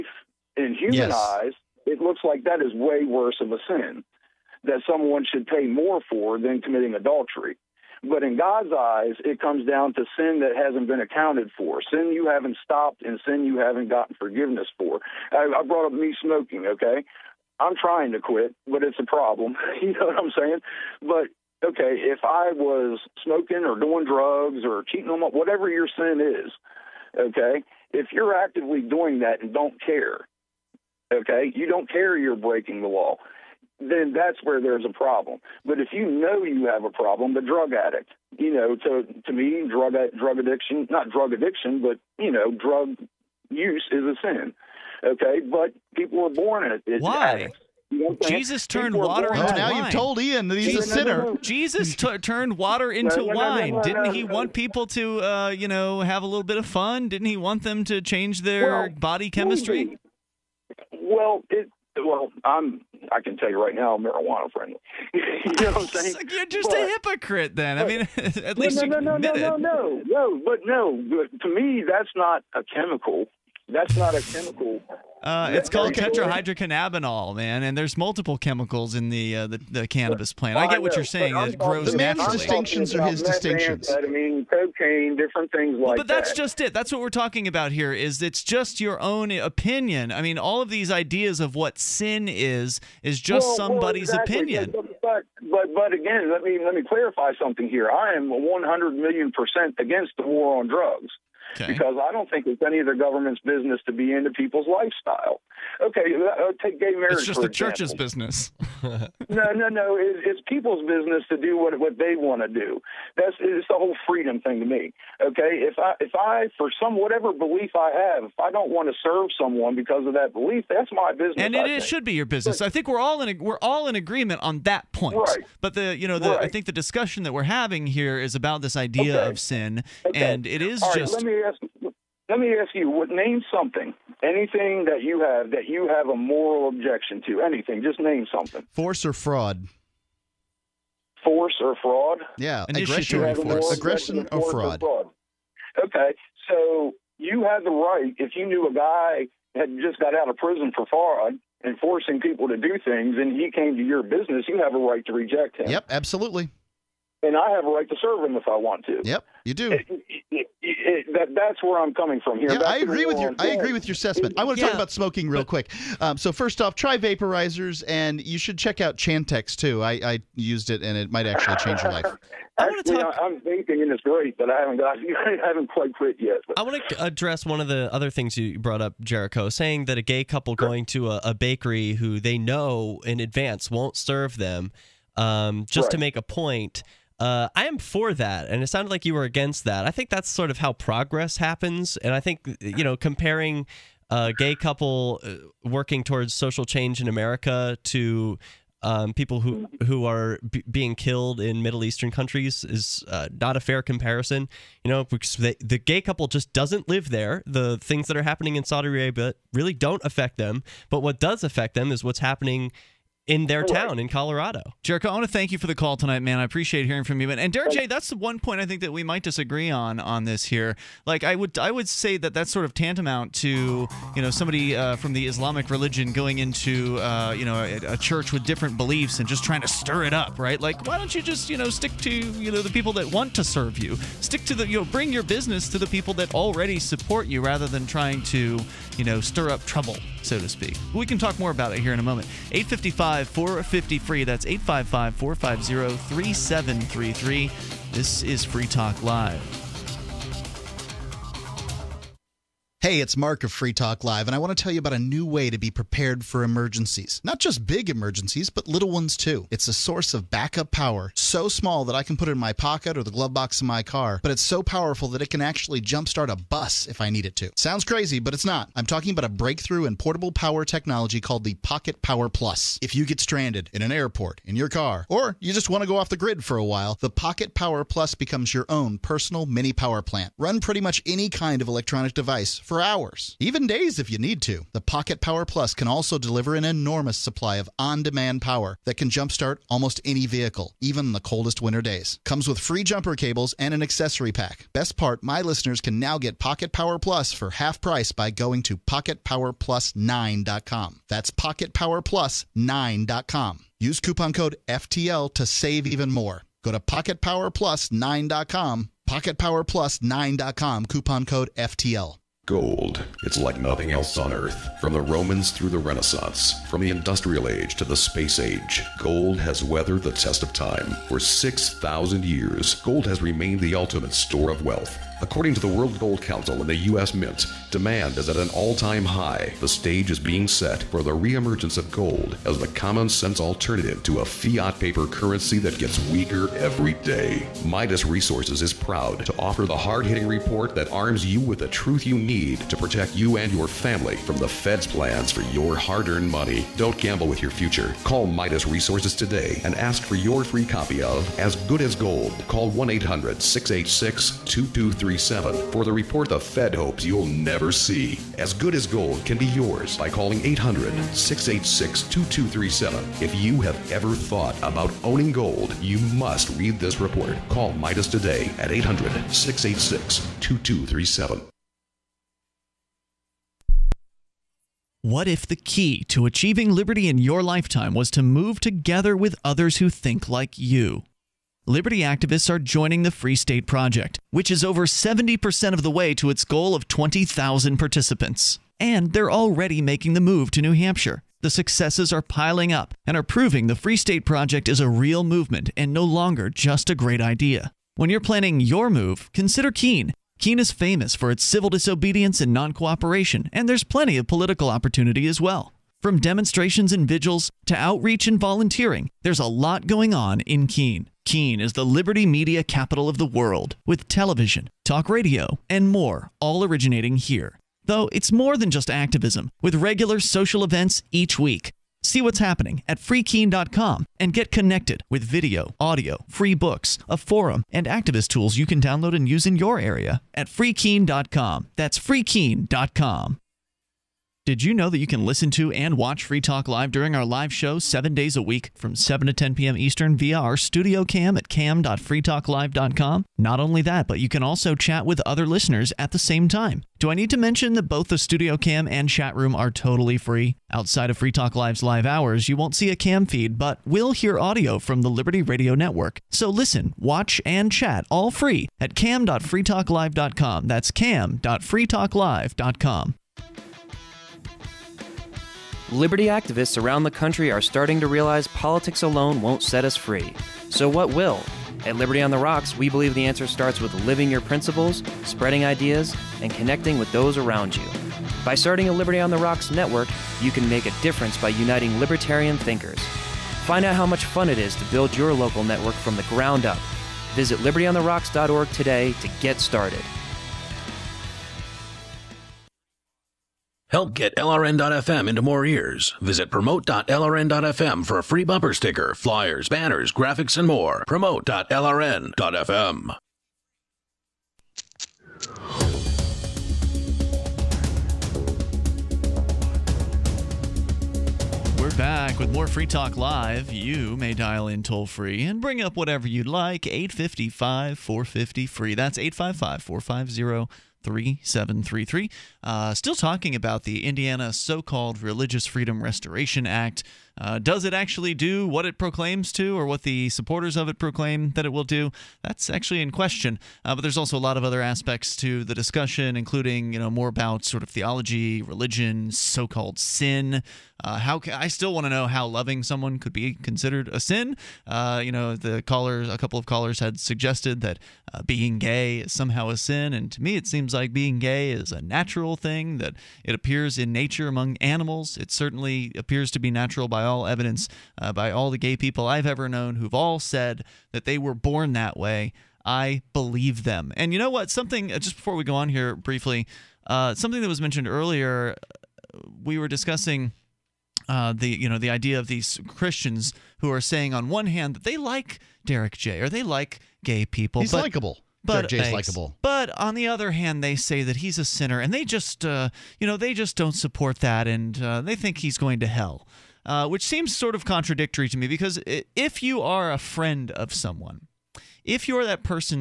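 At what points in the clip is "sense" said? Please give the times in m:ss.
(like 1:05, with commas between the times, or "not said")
5:33.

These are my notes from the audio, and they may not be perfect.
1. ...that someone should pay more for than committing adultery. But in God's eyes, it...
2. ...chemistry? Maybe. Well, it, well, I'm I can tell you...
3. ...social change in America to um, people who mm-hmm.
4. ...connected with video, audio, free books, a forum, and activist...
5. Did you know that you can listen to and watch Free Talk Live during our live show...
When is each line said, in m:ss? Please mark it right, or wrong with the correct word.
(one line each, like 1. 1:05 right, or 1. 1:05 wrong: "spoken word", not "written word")
1. 0:04 right
2. 0:59 right
3. 3:16 right
4. 7:04 right
5. 7:14 right.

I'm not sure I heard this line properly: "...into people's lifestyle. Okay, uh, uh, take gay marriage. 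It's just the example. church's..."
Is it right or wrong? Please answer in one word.
right.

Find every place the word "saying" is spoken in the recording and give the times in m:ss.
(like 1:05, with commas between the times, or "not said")
0:20, 1:05, 1:21, 2:59, 9:33.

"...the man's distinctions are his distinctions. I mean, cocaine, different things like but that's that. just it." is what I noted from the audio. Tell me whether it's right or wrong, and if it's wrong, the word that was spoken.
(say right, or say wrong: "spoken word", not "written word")
right.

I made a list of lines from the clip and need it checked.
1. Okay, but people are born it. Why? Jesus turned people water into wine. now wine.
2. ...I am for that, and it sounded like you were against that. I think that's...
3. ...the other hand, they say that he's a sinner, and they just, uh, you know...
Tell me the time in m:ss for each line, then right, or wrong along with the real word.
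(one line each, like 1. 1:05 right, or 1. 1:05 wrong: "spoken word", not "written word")
1. 0:45 right
2. 3:07 right
3. 9:40 right.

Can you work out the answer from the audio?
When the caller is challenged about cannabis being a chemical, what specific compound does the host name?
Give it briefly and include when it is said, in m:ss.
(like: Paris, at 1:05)
tetrahydrocannabinol, at 1:15.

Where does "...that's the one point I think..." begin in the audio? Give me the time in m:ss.
3:37.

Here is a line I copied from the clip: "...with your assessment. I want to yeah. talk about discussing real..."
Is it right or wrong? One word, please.
wrong.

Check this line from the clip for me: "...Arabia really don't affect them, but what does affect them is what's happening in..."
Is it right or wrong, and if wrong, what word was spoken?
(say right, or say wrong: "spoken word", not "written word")
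right.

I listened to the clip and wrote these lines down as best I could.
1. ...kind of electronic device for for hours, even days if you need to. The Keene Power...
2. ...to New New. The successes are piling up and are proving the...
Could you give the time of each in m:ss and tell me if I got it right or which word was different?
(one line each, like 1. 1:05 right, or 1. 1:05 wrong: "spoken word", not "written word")
1. 4:41 wrong: "Pocket", not "Keene"
2. 6:30 wrong: "Hampshire", not "New".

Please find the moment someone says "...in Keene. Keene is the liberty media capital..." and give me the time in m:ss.
6:50.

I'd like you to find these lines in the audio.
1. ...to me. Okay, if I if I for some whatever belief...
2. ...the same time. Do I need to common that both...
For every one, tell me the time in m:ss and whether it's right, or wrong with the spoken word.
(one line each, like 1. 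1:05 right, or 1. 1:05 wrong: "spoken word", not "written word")
1. 1:54 right
2. 7:26 wrong: "mention", not "common".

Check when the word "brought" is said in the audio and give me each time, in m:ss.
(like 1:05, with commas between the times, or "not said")
0:15, 2:58.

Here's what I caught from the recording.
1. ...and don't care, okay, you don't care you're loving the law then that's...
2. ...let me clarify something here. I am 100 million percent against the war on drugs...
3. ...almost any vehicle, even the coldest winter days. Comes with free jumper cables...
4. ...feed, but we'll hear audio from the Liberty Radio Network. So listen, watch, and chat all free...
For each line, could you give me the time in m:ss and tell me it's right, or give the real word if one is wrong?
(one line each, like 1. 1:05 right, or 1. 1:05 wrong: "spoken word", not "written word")
1. 0:29 wrong: "breaking", not "loving"
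2. 1:36 right
3. 4:49 right
4. 7:33 right.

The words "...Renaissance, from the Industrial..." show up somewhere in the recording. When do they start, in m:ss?
5:15.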